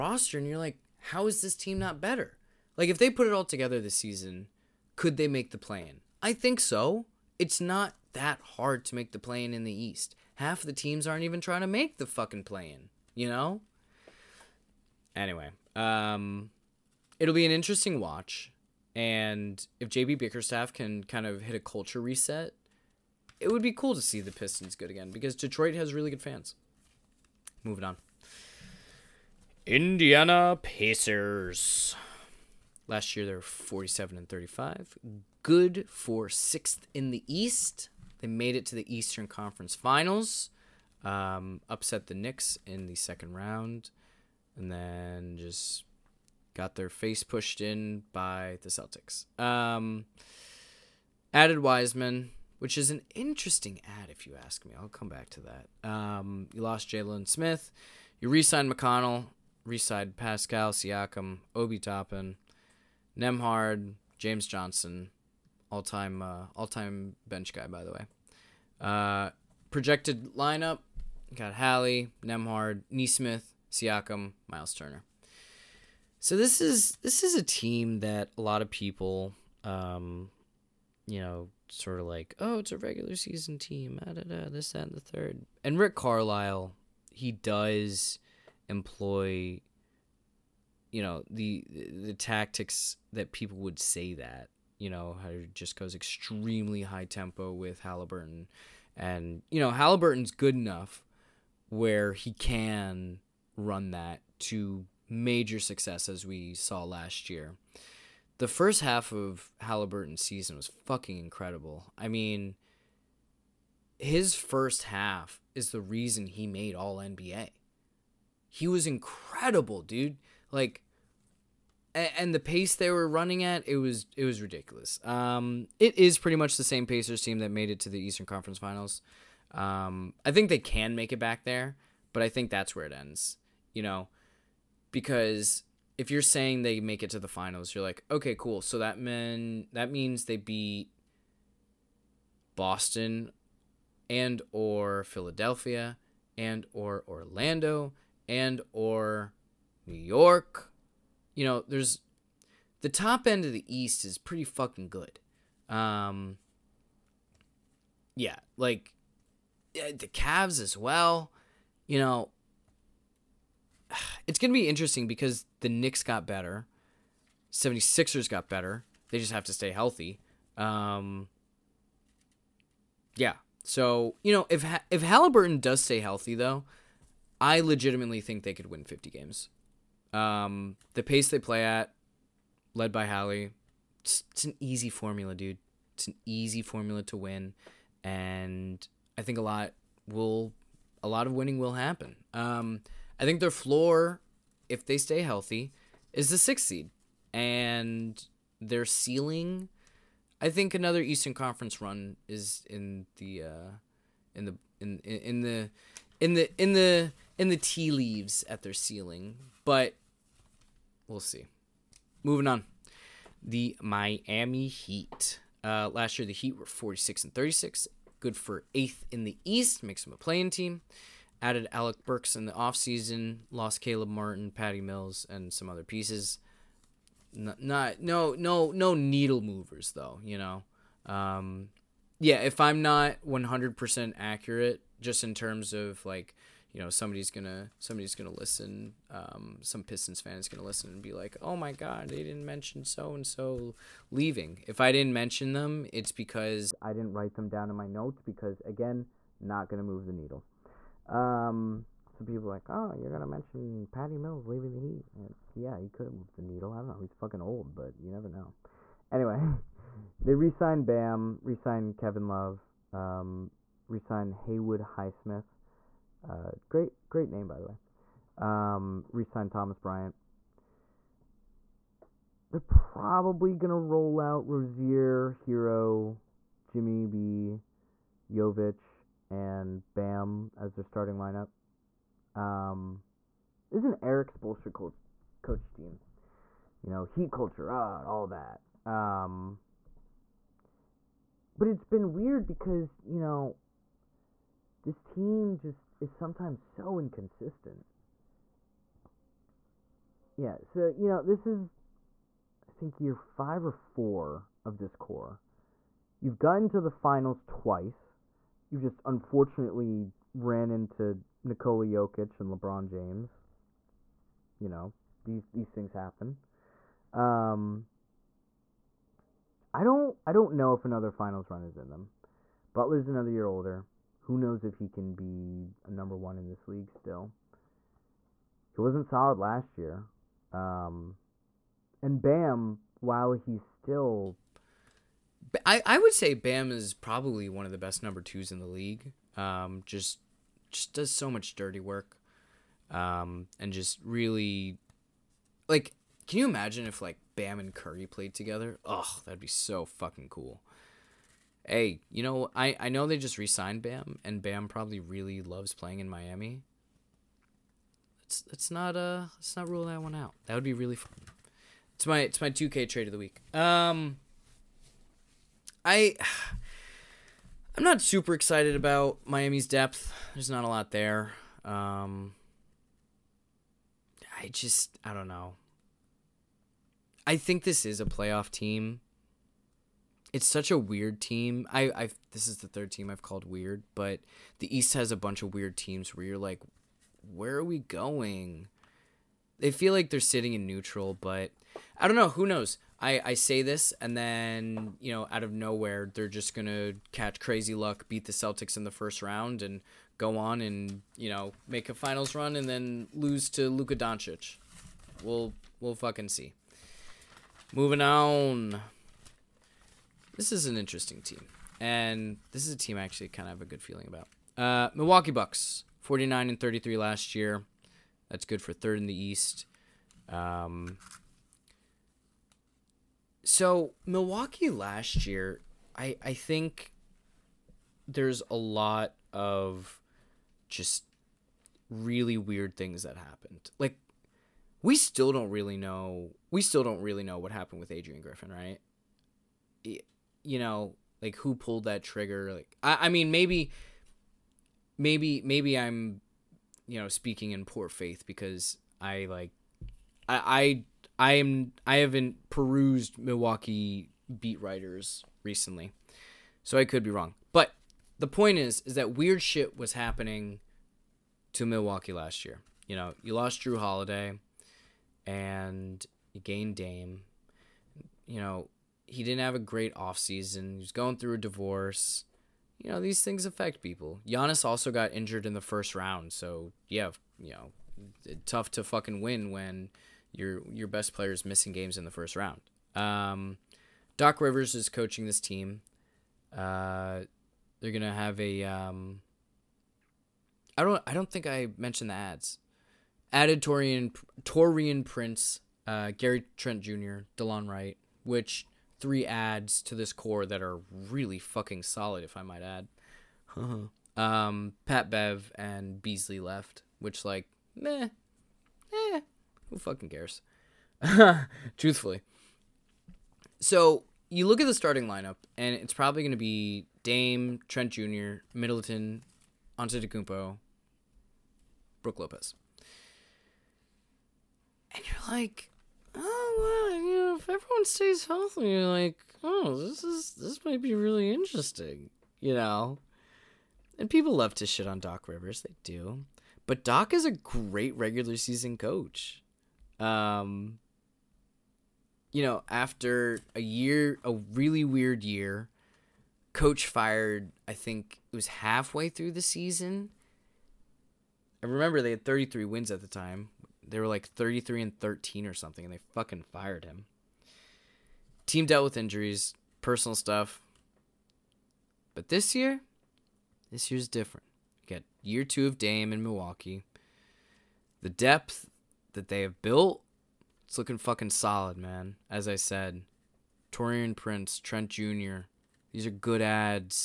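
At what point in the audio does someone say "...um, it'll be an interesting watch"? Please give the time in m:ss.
0:15.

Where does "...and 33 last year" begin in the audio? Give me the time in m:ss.
6:56.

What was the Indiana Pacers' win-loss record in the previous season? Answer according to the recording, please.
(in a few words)
47 and 35.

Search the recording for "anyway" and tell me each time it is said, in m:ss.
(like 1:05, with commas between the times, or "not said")
0:15, 4:19.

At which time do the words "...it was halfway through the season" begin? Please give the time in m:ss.
9:08.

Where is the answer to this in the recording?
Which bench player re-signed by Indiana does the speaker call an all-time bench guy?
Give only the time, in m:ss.
1:04.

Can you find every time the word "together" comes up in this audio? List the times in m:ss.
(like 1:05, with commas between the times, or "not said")
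0:03, 5:48.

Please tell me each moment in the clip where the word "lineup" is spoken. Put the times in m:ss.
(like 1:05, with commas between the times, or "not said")
1:10, 4:41, 8:35.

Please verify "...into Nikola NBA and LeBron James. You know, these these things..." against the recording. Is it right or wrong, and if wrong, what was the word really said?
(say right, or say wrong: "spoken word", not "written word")
wrong: "Jokic", not "NBA".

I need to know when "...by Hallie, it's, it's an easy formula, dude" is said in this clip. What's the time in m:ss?
3:02.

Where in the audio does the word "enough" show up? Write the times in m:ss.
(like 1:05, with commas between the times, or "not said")
1:40.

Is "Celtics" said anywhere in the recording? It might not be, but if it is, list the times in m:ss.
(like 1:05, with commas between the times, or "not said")
0:48, 6:38.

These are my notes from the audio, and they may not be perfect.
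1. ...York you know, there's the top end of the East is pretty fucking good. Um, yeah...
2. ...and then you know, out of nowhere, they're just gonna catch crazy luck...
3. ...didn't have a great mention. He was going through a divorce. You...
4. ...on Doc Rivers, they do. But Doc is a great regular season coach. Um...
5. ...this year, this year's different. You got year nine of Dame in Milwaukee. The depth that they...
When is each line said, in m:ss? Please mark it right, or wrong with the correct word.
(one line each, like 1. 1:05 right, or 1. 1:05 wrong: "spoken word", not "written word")
1. 2:29 right
2. 6:33 right
3. 7:49 wrong: "offseason", not "mention"
4. 8:54 right
5. 9:22 wrong: "two", not "nine".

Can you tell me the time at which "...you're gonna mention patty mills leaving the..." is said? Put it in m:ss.
4:12.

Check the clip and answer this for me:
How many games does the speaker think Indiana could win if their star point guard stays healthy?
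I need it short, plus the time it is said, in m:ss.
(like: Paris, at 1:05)
50, at 2:58.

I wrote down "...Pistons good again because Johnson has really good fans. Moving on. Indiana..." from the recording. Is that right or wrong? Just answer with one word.
wrong.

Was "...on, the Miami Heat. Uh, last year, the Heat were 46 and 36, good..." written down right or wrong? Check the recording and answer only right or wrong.
right.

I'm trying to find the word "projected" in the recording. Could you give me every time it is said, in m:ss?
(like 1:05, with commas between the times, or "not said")
1:09.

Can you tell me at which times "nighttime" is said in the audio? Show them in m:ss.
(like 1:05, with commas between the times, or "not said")
not said.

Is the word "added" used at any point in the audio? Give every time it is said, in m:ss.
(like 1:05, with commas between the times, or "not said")
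0:51, 3:41, 8:13.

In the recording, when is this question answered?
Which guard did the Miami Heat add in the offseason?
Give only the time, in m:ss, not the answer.
3:41.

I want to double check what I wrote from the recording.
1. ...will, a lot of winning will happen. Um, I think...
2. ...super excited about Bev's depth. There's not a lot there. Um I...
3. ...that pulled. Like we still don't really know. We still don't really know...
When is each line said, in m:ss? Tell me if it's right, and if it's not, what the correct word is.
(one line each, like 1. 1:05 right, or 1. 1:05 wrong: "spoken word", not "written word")
1. 3:10 right
2. 6:08 wrong: "Miami", not "Bev"
3. 7:13 wrong: "happened", not "pulled".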